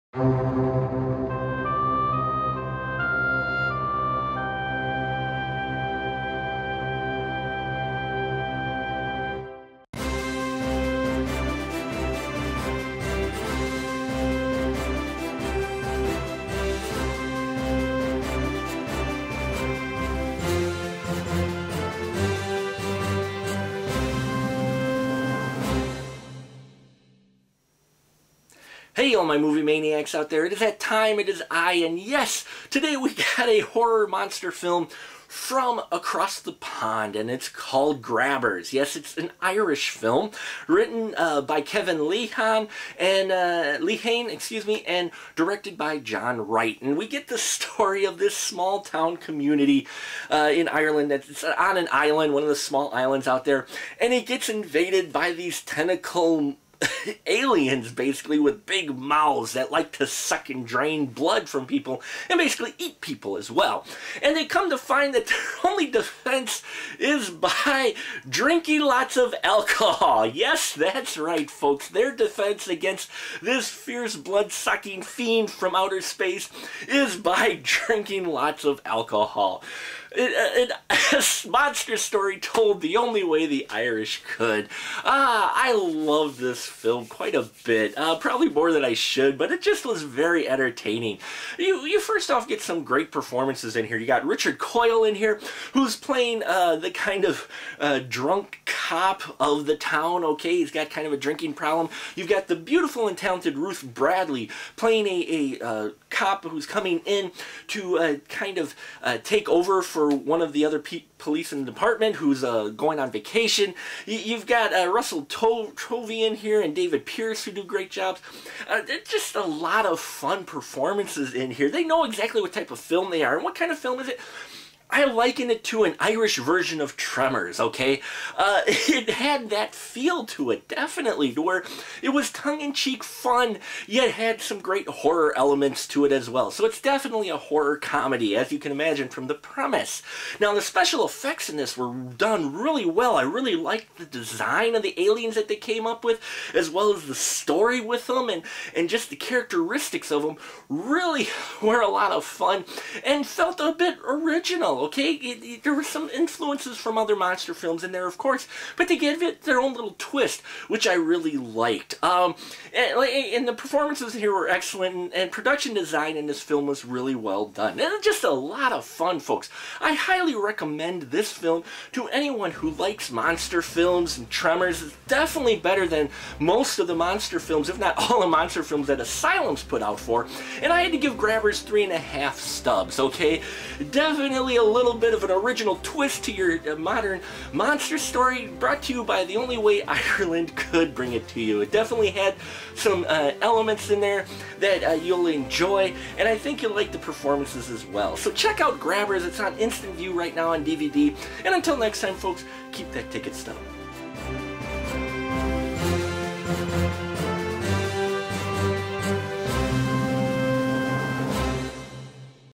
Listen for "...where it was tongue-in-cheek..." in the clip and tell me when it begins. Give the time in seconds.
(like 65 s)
131 s.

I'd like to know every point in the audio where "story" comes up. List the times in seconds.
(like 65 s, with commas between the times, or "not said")
47 s, 81 s, 147 s, 187 s.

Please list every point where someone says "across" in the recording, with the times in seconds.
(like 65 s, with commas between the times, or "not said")
35 s.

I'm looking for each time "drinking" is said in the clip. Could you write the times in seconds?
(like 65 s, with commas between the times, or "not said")
68 s, 77 s, 101 s.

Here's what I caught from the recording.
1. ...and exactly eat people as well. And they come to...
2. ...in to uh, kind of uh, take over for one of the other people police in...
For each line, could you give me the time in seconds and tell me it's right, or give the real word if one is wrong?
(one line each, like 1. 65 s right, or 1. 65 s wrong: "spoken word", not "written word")
1. 62 s wrong: "basically", not "exactly"
2. 107 s right.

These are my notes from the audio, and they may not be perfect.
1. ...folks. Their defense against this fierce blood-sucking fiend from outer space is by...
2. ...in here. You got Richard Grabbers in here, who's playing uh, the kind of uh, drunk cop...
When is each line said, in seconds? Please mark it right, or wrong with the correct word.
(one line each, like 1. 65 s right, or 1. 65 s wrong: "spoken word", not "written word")
1. 71 s right
2. 93 s wrong: "Coyle", not "Grabbers".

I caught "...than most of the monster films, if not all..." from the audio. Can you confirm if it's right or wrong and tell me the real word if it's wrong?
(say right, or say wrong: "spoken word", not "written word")
right.